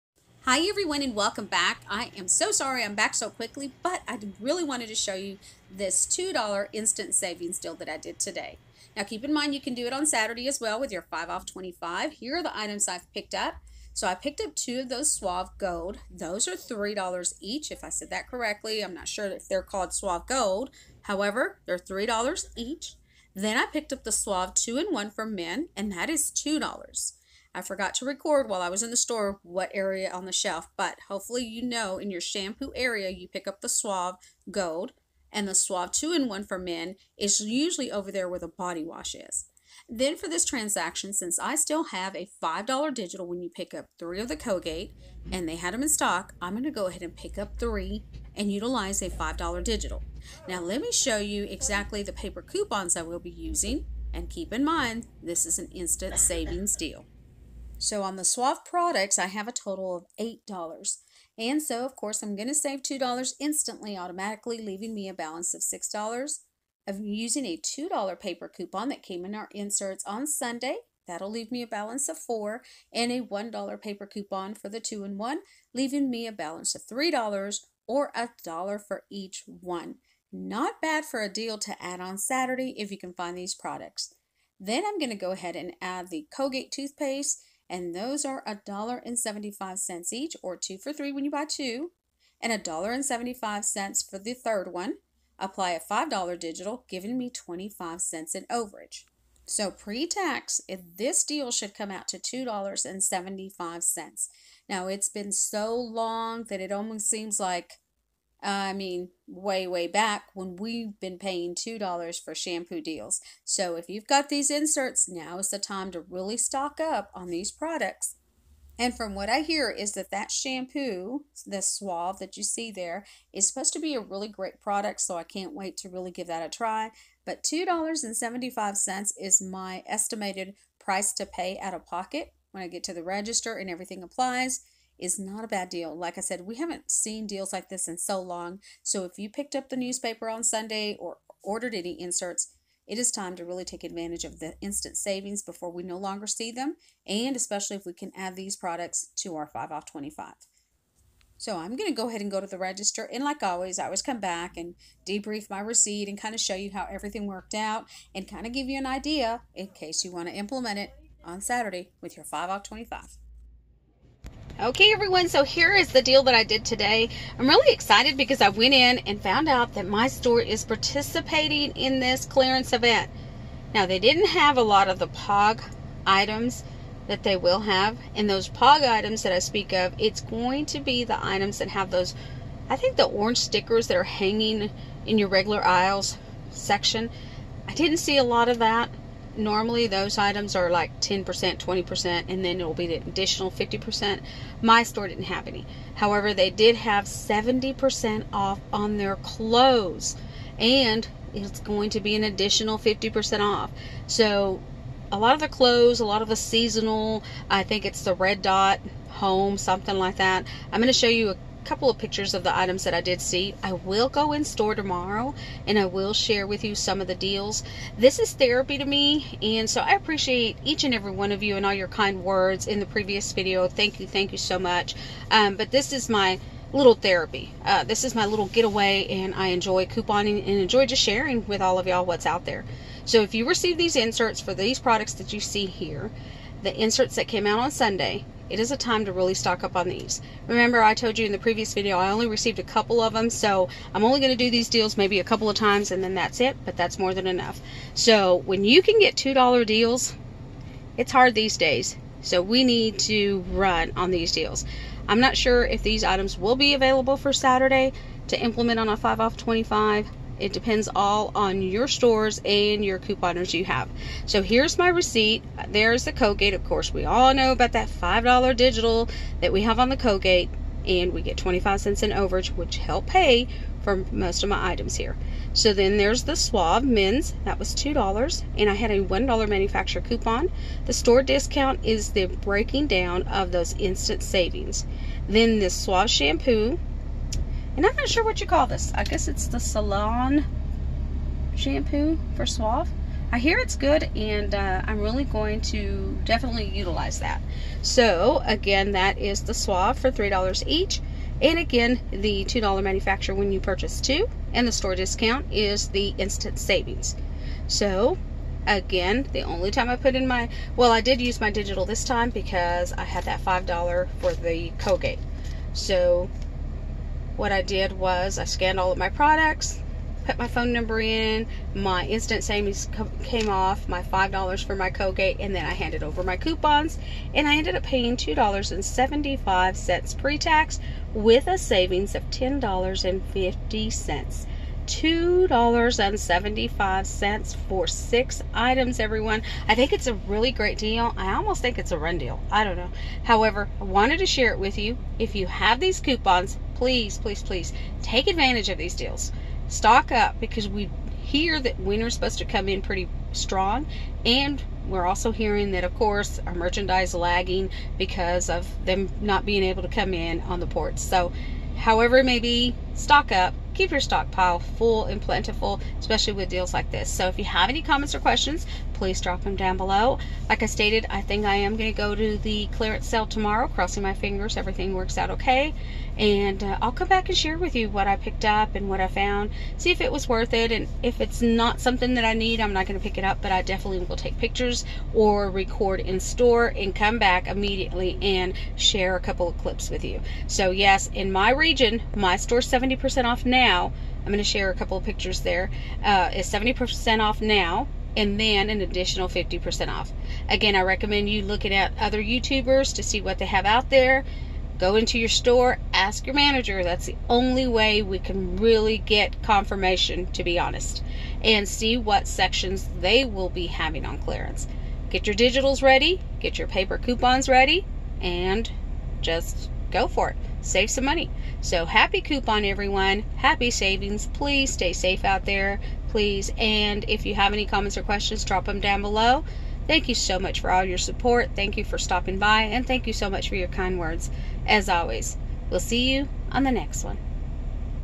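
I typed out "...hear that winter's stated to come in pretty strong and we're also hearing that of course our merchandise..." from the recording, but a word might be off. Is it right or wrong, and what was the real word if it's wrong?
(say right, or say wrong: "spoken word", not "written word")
wrong: "supposed", not "stated".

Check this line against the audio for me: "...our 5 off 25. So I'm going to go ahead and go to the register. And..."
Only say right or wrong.
right.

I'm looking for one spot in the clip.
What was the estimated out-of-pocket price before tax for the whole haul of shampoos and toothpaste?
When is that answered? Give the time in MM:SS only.
01:40.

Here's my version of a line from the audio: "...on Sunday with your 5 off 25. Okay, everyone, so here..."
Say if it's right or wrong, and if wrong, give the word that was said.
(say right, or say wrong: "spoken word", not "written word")
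wrong: "Saturday", not "Sunday".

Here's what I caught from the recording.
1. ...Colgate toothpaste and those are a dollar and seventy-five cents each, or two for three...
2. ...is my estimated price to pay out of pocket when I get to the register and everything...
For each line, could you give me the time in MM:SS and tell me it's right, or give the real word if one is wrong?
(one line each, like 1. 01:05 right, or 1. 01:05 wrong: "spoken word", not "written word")
1. 01:26 right
2. 02:09 right.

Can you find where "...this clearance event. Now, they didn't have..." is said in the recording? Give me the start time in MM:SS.
02:51.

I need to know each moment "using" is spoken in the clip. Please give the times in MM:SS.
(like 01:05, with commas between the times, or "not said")
00:53, 01:06.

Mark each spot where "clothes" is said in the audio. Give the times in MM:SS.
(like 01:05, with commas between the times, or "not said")
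03:19, 03:25.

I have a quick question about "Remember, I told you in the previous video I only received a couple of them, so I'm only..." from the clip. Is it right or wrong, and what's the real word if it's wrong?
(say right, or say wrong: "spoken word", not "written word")
right.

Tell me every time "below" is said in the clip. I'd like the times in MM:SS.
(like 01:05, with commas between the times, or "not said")
06:09, 07:09.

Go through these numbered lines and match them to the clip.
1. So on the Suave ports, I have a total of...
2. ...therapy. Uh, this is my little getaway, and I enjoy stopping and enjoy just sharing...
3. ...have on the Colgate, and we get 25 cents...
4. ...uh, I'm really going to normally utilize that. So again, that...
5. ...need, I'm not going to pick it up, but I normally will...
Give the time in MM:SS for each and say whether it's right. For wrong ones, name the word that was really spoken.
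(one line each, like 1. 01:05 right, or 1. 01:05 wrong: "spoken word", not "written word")
1. 00:57 wrong: "products", not "ports"
2. 03:46 wrong: "couponing", not "stopping"
3. 04:29 right
4. 04:54 wrong: "definitely", not "normally"
5. 06:22 wrong: "definitely", not "normally".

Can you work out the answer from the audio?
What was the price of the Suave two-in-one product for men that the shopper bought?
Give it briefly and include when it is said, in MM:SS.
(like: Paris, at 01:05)
$2, at 00:25.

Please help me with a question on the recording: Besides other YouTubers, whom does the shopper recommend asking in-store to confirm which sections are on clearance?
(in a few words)
your manager.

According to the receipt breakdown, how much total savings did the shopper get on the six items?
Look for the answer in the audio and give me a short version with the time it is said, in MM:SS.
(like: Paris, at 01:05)
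$10.50, at 05:32.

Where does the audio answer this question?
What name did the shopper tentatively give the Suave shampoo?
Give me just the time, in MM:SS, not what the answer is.
04:49.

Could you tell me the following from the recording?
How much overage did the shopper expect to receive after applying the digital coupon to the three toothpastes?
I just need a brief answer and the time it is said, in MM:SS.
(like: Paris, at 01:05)
25 cents, at 01:36.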